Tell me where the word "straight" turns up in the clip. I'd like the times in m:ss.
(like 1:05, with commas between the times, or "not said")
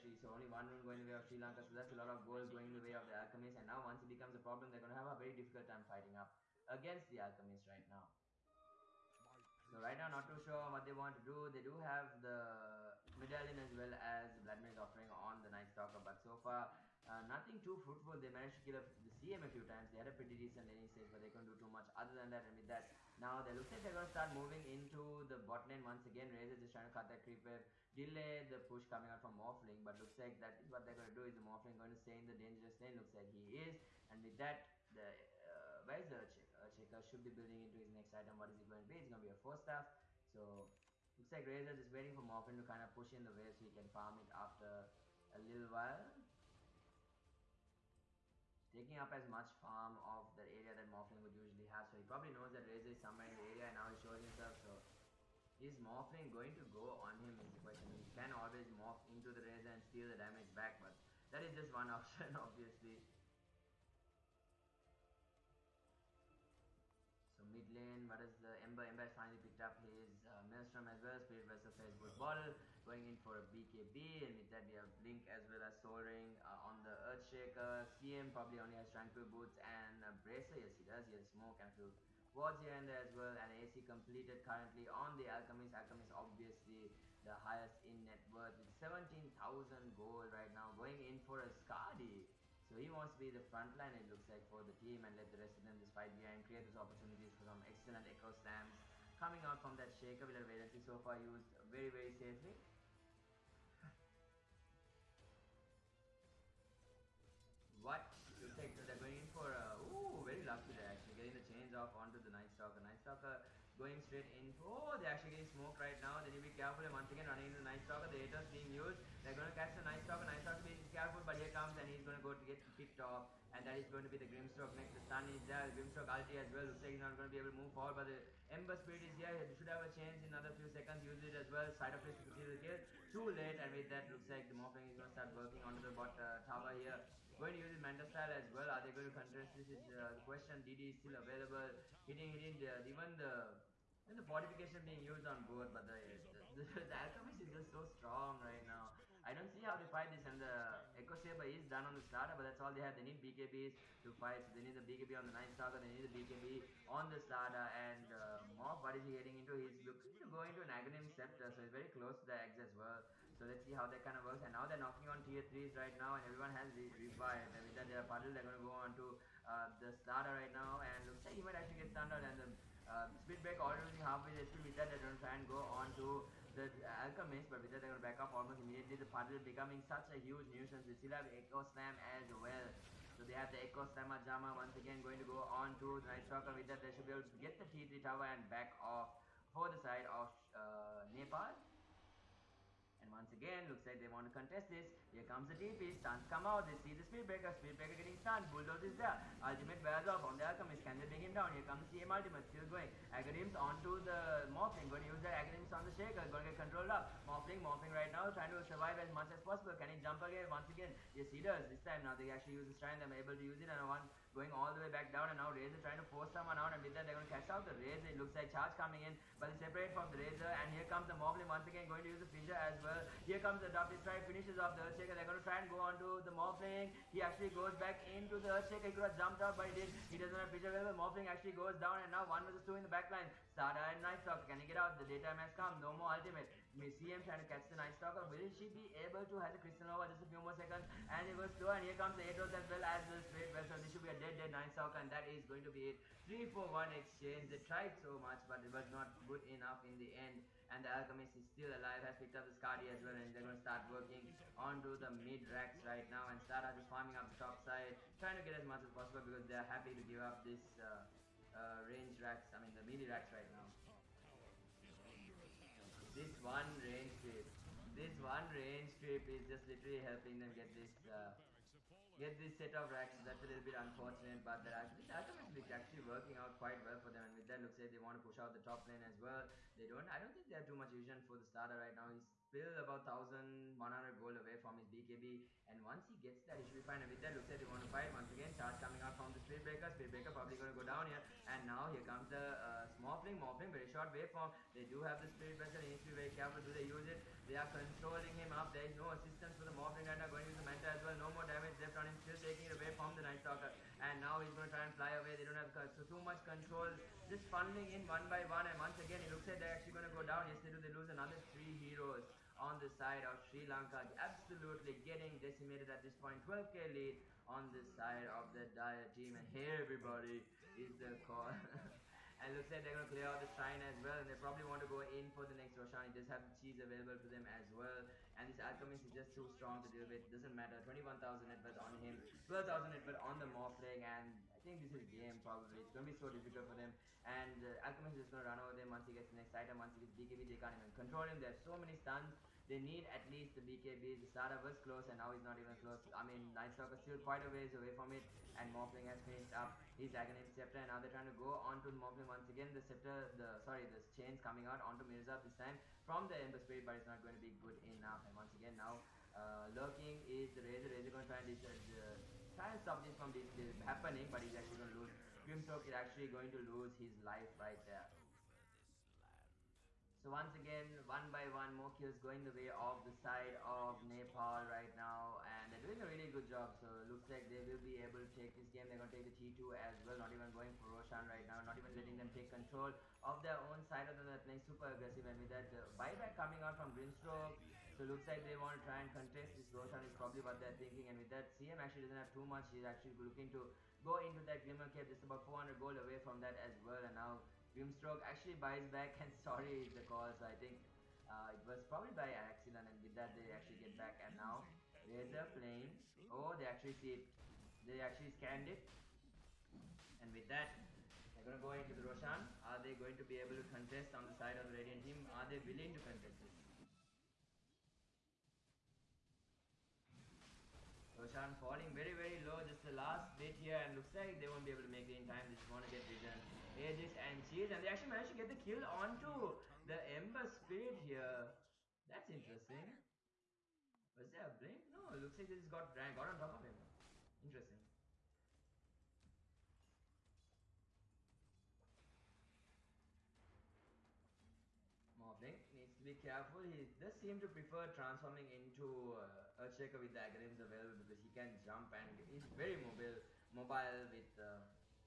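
1:54, 4:03.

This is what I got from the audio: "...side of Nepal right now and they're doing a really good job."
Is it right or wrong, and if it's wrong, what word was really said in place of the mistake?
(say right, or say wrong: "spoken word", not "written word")
right.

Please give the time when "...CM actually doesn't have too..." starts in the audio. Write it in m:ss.
6:31.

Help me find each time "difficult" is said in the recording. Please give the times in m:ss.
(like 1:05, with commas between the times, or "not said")
0:05, 5:36.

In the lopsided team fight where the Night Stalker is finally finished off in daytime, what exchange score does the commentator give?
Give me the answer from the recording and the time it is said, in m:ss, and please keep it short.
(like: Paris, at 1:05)
3 4 1, at 4:06.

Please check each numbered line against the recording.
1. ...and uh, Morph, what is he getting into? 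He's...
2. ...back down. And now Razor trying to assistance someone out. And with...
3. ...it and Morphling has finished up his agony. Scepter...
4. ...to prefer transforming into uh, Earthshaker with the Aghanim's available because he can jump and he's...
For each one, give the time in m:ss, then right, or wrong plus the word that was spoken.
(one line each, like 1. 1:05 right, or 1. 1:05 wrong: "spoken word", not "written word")
1. 2:37 right
2. 3:34 wrong: "force", not "assistance"
3. 5:48 right
4. 7:27 right.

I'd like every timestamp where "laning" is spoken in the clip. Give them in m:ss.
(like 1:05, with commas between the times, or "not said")
0:20.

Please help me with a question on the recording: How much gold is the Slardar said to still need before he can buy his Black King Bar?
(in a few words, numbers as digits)
1,100 gold.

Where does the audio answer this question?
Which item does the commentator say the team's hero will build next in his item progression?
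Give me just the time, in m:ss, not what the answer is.
0:39.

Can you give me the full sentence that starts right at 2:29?
I don't see how they fight this, and the Echo Saber is done on the starter, but that's all they have.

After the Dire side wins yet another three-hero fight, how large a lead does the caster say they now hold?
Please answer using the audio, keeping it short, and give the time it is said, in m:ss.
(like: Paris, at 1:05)
12k, at 5:16.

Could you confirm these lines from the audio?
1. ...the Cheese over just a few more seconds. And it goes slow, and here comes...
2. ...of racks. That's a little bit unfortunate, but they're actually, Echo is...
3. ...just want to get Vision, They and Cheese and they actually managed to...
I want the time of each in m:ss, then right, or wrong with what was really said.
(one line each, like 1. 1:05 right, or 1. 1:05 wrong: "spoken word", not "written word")
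1. 3:59 wrong: "Crystal", not "Cheese"
2. 4:32 wrong: "Alchemist", not "Echo"
3. 7:05 wrong: "Aegis", not "They".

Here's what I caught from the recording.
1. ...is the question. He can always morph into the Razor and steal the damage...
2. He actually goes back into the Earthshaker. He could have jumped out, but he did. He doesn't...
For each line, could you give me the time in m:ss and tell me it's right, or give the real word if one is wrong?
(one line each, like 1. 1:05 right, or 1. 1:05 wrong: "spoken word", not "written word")
1. 0:57 right
2. 3:47 right.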